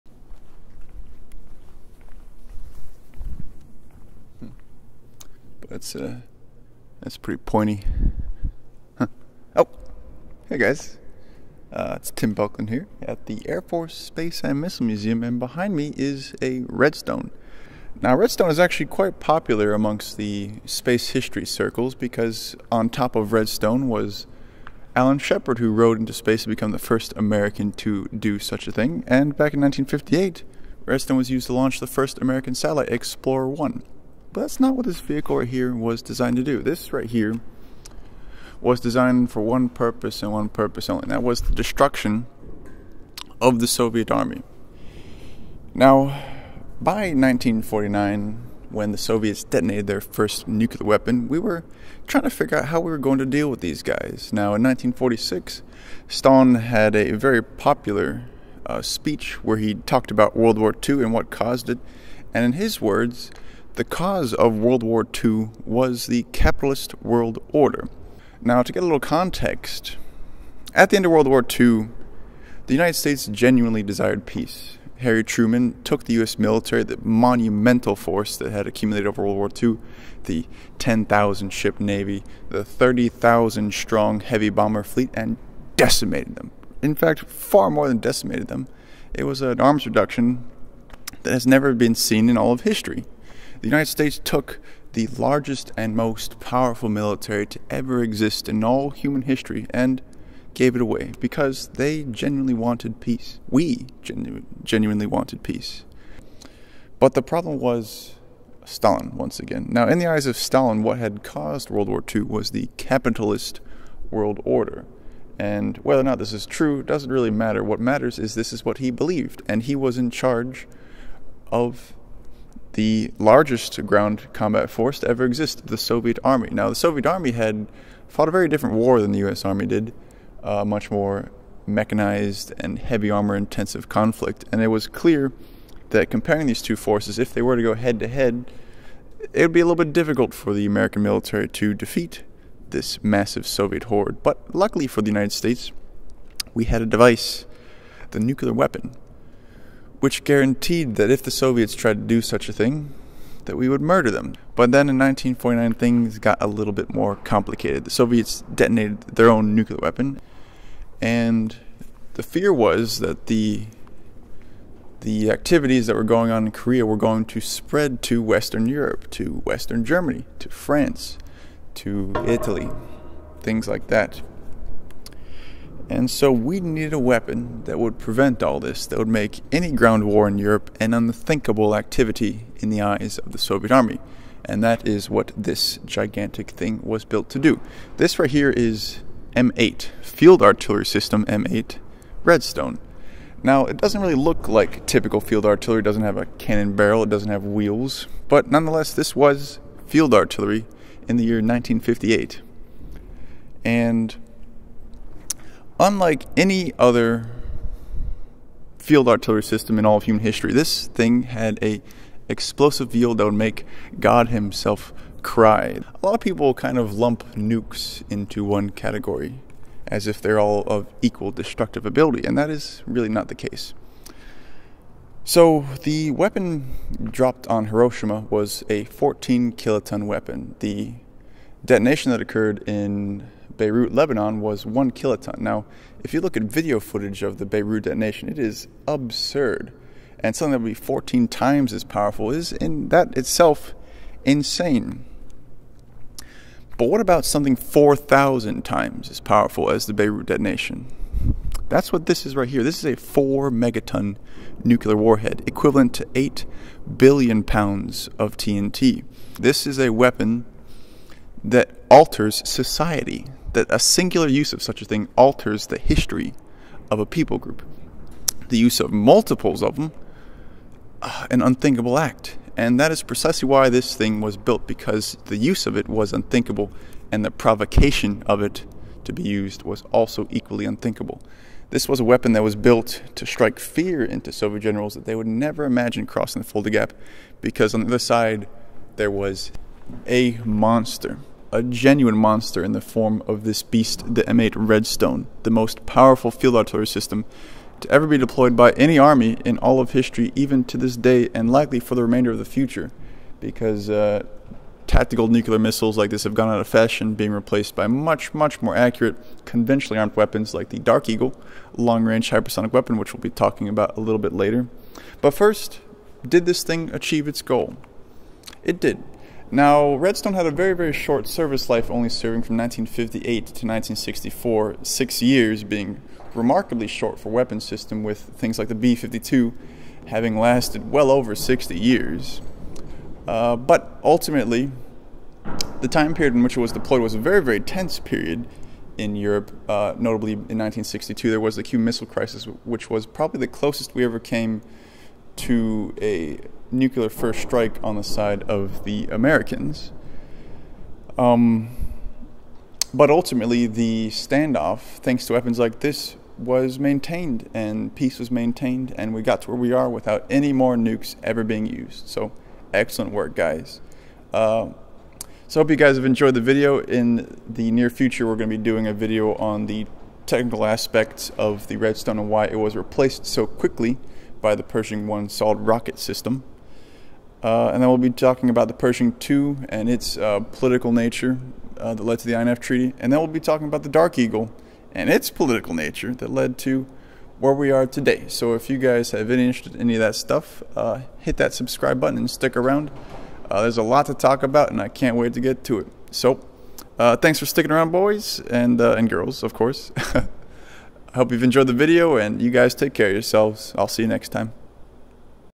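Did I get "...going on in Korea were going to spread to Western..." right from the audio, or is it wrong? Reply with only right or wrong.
right.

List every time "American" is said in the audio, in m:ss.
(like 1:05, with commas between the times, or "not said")
0:27, 0:32, 2:20, 5:49.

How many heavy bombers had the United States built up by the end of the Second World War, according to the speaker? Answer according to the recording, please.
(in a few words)
30,000.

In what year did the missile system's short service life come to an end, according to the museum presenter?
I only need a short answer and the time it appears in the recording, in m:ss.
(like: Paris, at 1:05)
1964, at 5:23.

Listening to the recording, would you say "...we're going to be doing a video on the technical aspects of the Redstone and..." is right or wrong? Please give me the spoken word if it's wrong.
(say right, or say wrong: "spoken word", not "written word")
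right.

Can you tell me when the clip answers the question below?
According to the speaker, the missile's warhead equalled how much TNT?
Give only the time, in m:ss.
4:16.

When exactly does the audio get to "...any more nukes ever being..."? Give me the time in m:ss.
6:00.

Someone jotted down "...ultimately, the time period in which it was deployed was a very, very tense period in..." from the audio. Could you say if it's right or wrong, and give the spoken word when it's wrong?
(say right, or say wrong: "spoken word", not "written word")
right.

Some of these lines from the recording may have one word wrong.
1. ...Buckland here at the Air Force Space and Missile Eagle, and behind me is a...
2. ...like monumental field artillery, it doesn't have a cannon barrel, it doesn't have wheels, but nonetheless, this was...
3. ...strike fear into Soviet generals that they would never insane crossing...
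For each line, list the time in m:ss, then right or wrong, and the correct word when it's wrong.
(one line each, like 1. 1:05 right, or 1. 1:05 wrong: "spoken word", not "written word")
1. 0:12 wrong: "Museum", not "Eagle"
2. 3:14 wrong: "typical", not "monumental"
3. 4:43 wrong: "imagine", not "insane".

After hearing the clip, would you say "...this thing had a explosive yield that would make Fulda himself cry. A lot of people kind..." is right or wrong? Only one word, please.
wrong.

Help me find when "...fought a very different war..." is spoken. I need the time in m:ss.
2:08.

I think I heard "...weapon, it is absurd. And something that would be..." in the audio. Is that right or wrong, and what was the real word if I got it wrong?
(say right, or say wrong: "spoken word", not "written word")
wrong: "detonation", not "weapon".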